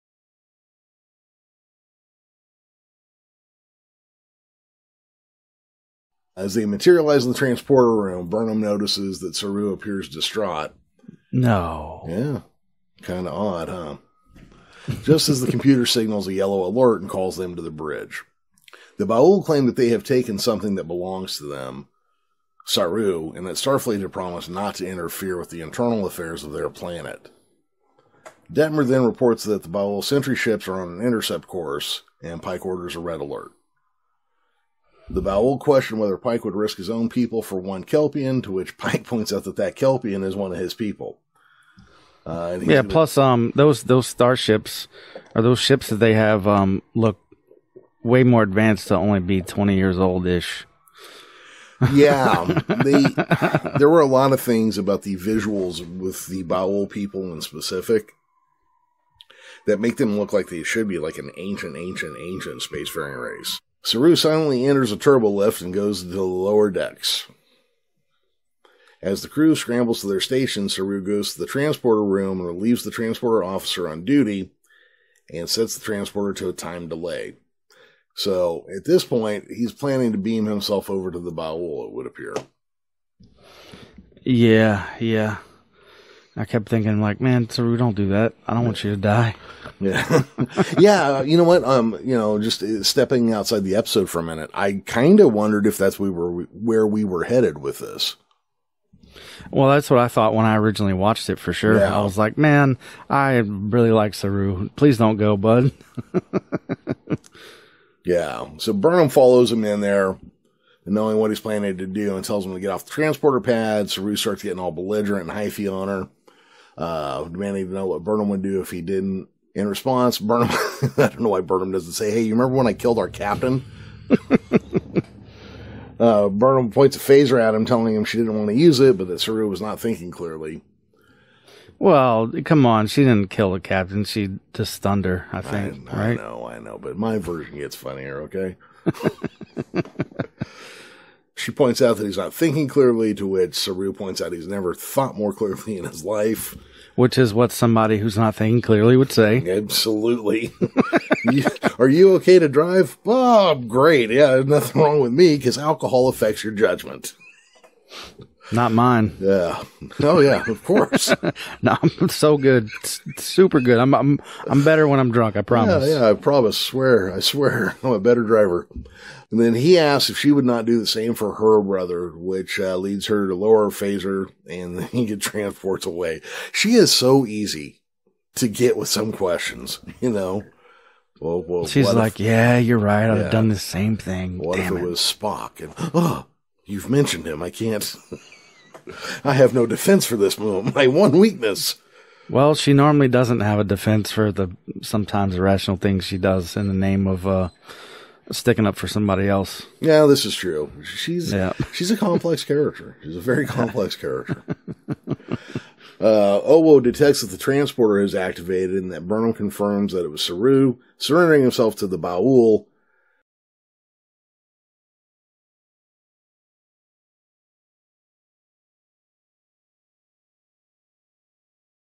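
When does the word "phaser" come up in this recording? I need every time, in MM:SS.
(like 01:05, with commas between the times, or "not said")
02:06, 02:53.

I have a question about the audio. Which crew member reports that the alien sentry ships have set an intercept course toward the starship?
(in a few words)
Detmer.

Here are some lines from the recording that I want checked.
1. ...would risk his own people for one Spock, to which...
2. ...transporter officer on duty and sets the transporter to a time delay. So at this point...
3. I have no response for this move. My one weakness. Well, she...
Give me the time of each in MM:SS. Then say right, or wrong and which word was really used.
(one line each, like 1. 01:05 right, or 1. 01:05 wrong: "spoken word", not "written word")
1. 00:36 wrong: "Kelpian", not "Spock"
2. 01:12 right
3. 03:09 wrong: "defense", not "response".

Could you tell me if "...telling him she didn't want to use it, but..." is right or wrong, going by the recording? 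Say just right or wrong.
right.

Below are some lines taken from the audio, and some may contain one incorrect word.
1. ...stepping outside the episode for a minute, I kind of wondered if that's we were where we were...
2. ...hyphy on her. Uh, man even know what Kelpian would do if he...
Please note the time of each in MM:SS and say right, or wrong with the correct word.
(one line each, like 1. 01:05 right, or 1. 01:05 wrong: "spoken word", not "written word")
1. 01:32 right
2. 01:55 wrong: "Burnham", not "Kelpian".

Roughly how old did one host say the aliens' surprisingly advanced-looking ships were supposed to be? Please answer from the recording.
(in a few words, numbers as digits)
20 years.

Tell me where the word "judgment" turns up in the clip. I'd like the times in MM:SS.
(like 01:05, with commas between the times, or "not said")
02:36.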